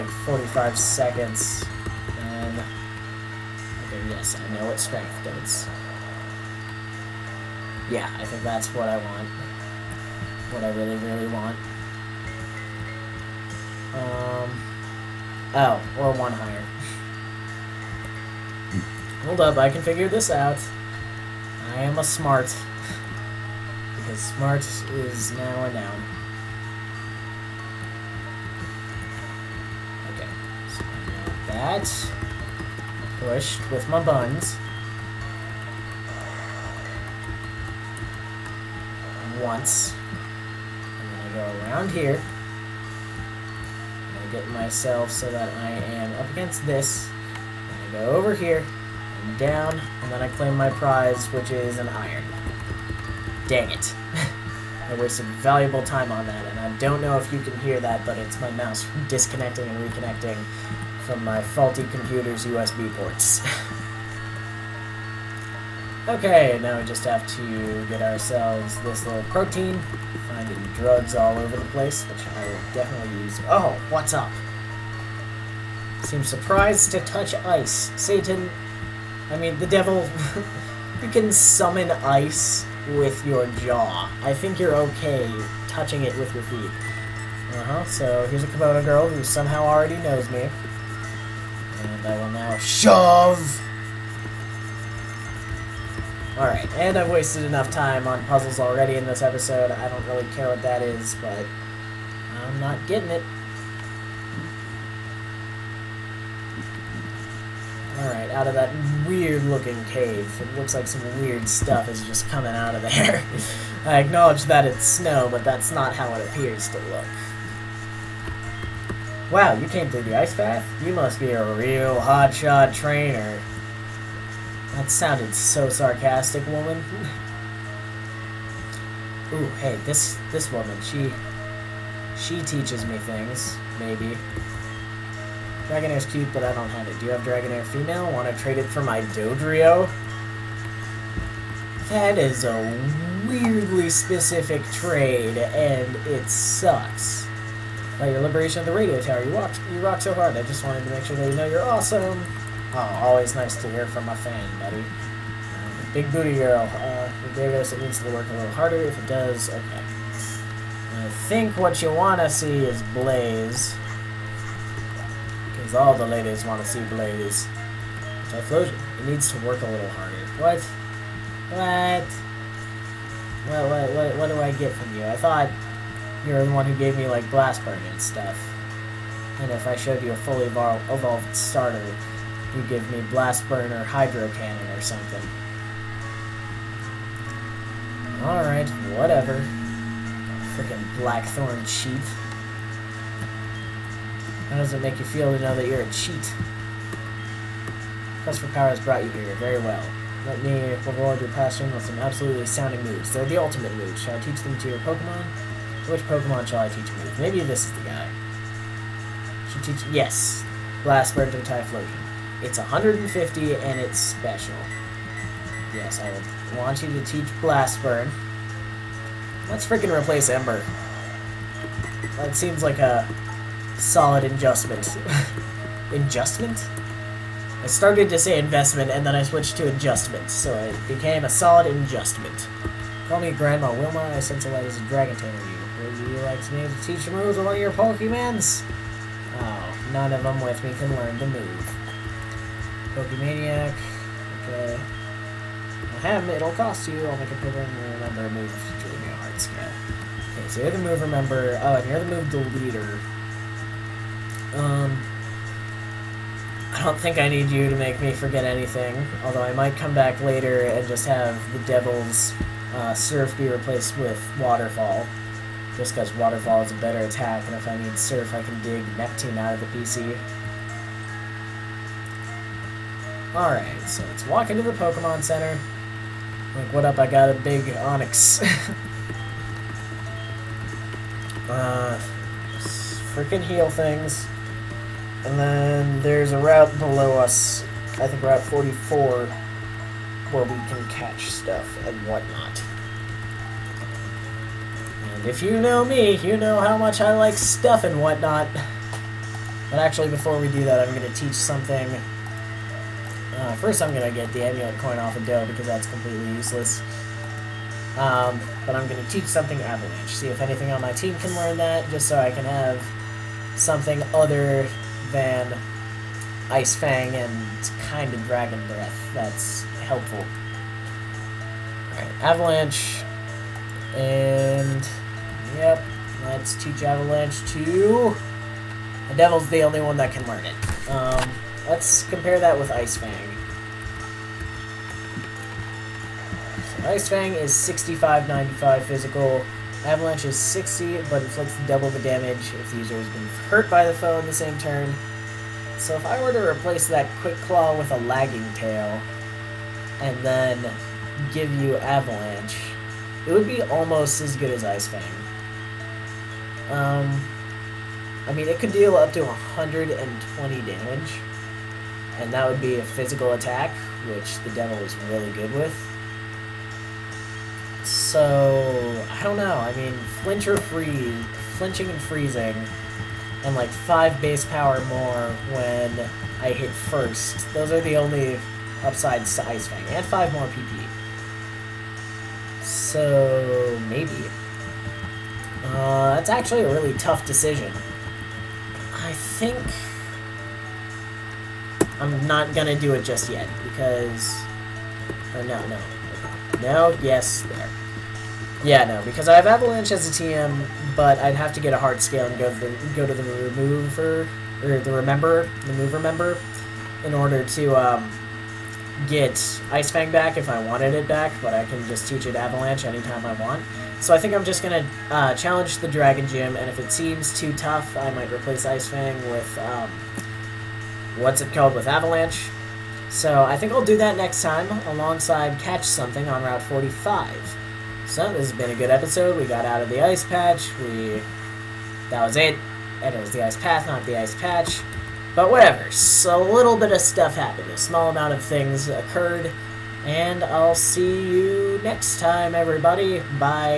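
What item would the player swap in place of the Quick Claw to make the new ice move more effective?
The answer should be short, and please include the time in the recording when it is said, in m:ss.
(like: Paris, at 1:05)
Lagging Tail, at 5:47.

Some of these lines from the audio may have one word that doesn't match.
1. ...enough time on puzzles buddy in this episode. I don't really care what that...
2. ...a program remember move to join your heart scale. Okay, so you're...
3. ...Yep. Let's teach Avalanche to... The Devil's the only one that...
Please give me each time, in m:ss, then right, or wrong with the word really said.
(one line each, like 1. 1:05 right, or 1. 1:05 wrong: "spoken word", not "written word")
1. 1:37 wrong: "already", not "buddy"
2. 4:07 right
3. 5:25 right.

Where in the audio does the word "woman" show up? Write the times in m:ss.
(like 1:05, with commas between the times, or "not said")
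2:06, 2:10.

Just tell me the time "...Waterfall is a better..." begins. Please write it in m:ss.
4:26.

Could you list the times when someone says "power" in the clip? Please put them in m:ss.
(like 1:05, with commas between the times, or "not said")
3:18, 6:14.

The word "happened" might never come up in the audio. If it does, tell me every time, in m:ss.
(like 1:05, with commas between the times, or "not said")
7:17.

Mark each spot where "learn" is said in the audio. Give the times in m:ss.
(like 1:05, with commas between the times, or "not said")
4:00, 5:11, 5:30.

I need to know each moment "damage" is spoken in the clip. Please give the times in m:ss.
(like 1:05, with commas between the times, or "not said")
5:41, 6:00.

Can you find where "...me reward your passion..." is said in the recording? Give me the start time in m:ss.
3:20.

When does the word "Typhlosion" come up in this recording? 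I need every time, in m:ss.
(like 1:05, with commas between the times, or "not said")
2:48, 3:31.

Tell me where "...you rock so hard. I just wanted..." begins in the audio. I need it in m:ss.
2:29.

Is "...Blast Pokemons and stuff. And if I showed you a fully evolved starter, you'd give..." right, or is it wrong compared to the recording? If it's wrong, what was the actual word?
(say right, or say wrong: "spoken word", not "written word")
wrong: "Burn", not "Pokemons".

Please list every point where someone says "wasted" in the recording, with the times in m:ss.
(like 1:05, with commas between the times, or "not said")
0:54, 1:37.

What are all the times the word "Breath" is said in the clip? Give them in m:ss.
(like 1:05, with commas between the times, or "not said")
5:18.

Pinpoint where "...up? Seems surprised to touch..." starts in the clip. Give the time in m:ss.
1:14.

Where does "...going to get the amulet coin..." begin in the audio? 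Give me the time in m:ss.
5:03.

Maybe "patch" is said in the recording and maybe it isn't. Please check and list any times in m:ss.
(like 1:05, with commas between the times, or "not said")
7:10, 7:14.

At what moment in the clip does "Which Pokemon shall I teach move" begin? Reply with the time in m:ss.
3:25.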